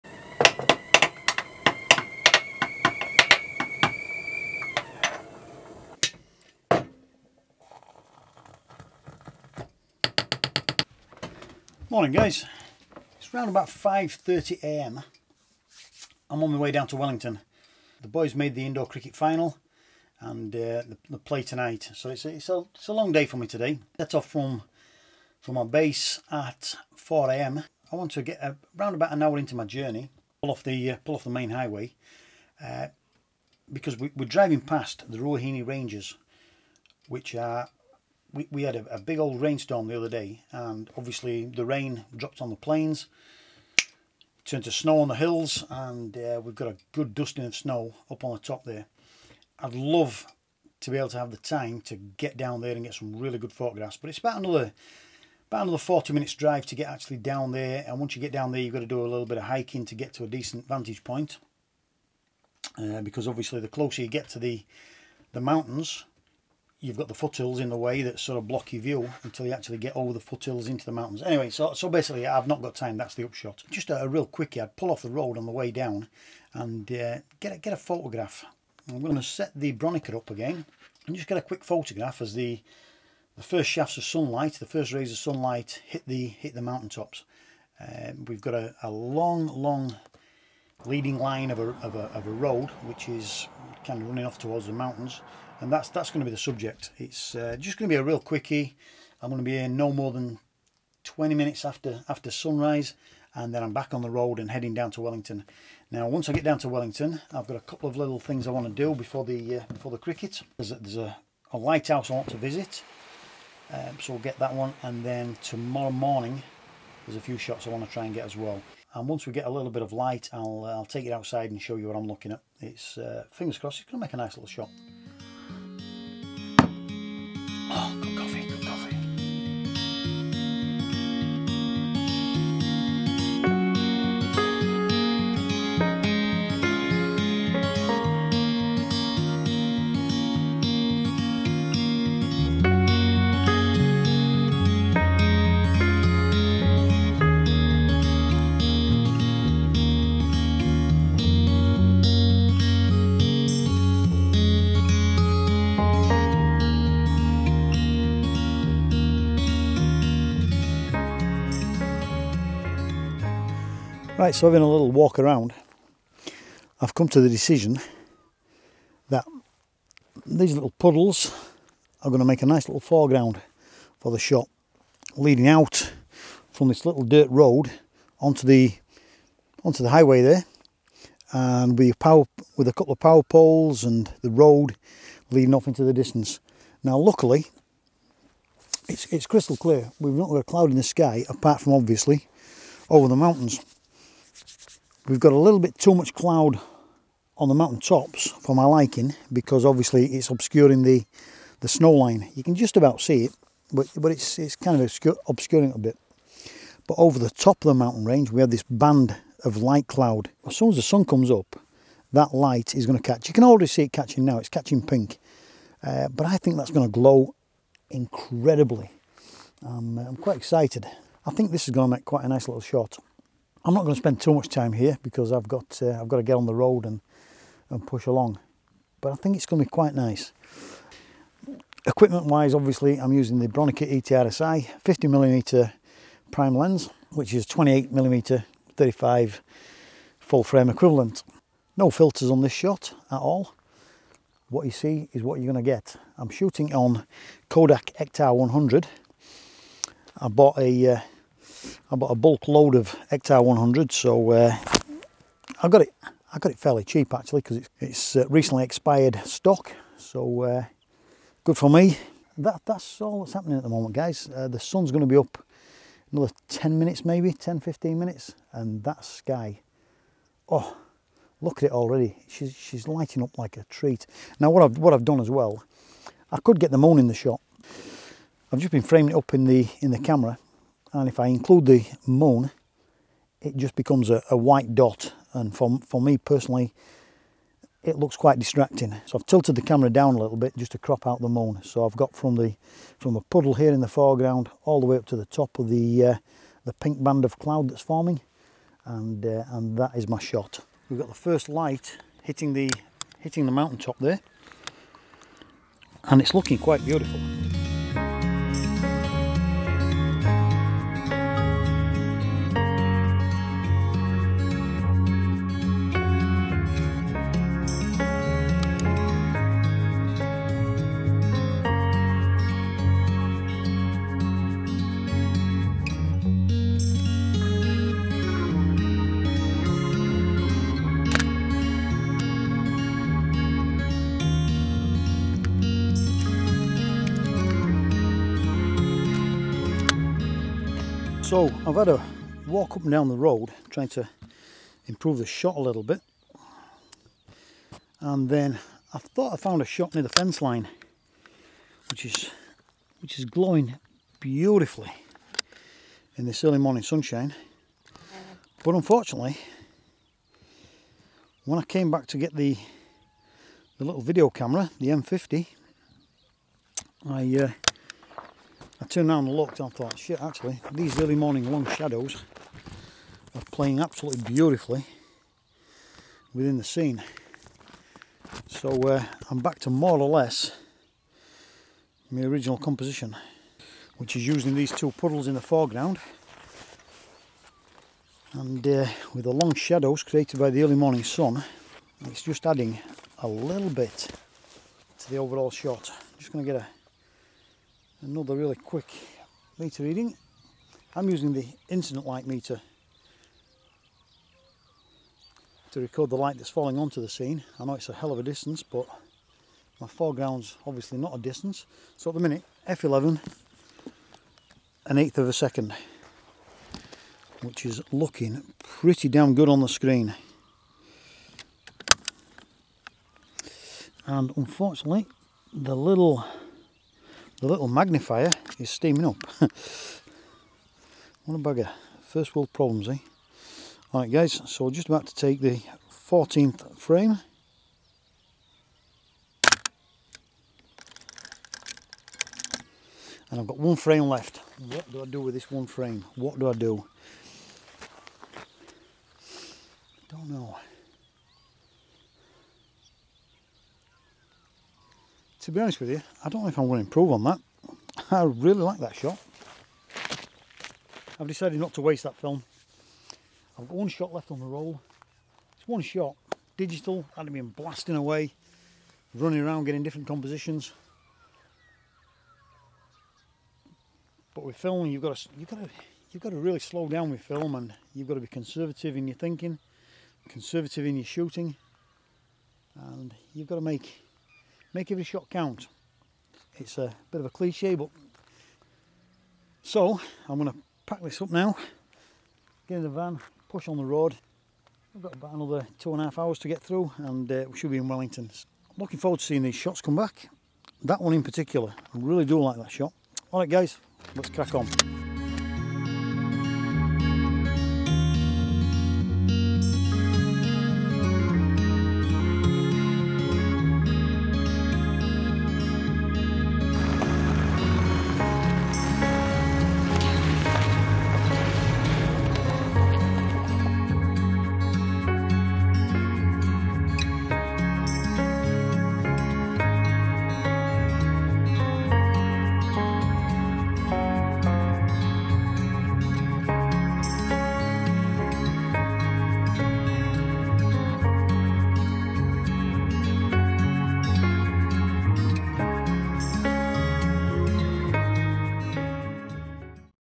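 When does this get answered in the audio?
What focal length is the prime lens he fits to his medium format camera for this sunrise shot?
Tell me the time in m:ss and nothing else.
3:54.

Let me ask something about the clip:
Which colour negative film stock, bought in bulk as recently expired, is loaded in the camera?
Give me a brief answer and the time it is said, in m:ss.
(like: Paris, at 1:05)
Kodak Ektar 100, at 4:07.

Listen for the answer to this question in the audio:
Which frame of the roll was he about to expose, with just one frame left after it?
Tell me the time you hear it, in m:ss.
7:15.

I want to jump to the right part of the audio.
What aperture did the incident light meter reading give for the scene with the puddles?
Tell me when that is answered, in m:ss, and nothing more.
6:52.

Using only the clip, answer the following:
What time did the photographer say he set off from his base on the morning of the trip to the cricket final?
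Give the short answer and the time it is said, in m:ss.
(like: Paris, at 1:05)
4am, at 0:26.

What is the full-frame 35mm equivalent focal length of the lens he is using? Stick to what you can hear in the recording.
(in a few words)
28mm.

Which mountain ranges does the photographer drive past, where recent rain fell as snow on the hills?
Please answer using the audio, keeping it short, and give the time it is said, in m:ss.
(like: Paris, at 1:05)
Ruahine Ranges, at 0:35.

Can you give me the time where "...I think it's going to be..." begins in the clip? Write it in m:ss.
3:49.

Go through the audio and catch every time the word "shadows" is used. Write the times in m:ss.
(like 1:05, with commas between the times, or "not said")
6:11, 6:29.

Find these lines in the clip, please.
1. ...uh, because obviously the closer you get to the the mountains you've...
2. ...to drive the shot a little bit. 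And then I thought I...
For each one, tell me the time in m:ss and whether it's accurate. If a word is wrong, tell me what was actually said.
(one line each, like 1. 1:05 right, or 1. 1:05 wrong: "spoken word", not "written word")
1. 1:02 right
2. 5:43 wrong: "improve", not "drive".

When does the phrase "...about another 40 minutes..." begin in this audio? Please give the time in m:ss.
0:55.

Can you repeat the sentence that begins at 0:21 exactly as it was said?
So it's a, it's, a, it's a long day for me today.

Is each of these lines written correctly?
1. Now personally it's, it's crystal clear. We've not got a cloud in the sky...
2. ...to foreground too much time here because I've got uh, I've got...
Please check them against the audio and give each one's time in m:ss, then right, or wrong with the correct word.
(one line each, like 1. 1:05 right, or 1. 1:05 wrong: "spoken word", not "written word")
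1. 3:06 wrong: "luckily", not "personally"
2. 3:43 wrong: "spend", not "foreground".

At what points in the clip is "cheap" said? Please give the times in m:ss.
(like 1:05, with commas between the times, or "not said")
4:16.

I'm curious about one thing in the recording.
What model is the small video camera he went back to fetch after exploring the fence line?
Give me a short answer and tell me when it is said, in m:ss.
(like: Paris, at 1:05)
M50, at 6:04.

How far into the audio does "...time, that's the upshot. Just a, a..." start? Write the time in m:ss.
1:12.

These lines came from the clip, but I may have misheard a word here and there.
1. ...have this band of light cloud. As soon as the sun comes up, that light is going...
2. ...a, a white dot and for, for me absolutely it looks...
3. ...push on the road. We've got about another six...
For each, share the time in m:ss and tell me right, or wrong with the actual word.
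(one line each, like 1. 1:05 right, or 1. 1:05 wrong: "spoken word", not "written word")
1. 3:28 right
2. 4:44 wrong: "personally", not "absolutely"
3. 8:13 wrong: "two", not "six".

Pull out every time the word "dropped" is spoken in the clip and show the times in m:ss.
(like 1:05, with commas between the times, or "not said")
0:42.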